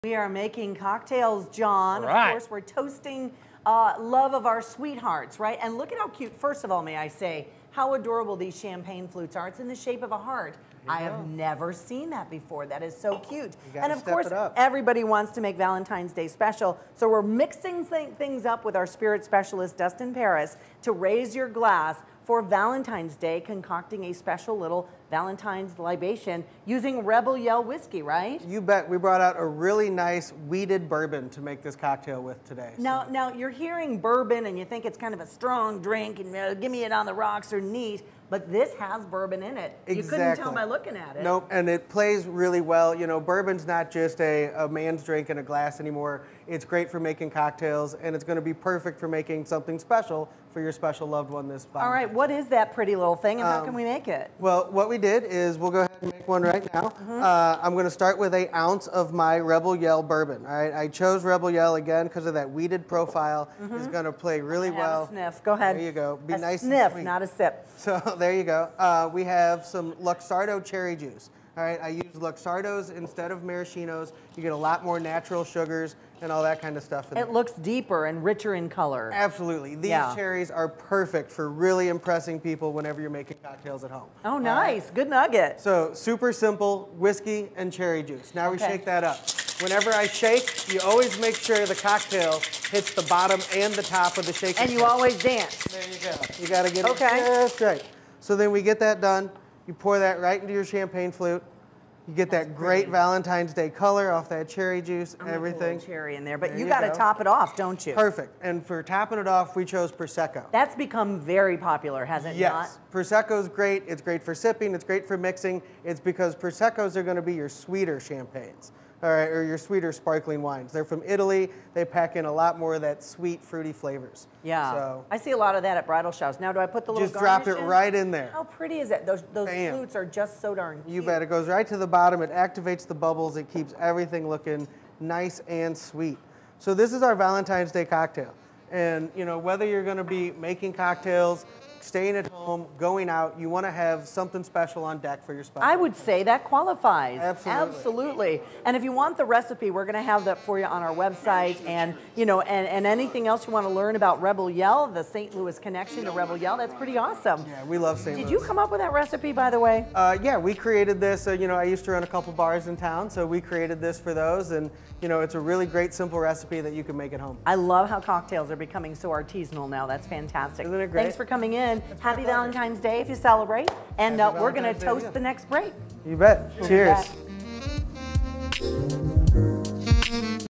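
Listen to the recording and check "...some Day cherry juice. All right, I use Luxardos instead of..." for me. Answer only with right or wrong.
wrong.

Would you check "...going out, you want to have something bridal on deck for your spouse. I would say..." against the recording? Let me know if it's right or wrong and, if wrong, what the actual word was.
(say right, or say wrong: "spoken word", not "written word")
wrong: "special", not "bridal".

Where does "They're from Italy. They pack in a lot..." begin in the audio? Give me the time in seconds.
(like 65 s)
120 s.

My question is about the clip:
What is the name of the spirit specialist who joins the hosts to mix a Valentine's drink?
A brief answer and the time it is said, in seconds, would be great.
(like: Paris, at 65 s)
Dustin Paris, at 19 s.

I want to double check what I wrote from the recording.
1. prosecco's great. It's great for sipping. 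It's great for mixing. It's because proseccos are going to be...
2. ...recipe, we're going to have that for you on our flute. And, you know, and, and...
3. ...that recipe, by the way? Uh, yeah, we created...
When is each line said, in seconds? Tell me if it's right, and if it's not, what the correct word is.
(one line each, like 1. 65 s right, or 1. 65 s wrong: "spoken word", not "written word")
1. 112 s right
2. 149 s wrong: "website", not "flute"
3. 158 s right.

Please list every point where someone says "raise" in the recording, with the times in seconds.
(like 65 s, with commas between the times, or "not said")
20 s.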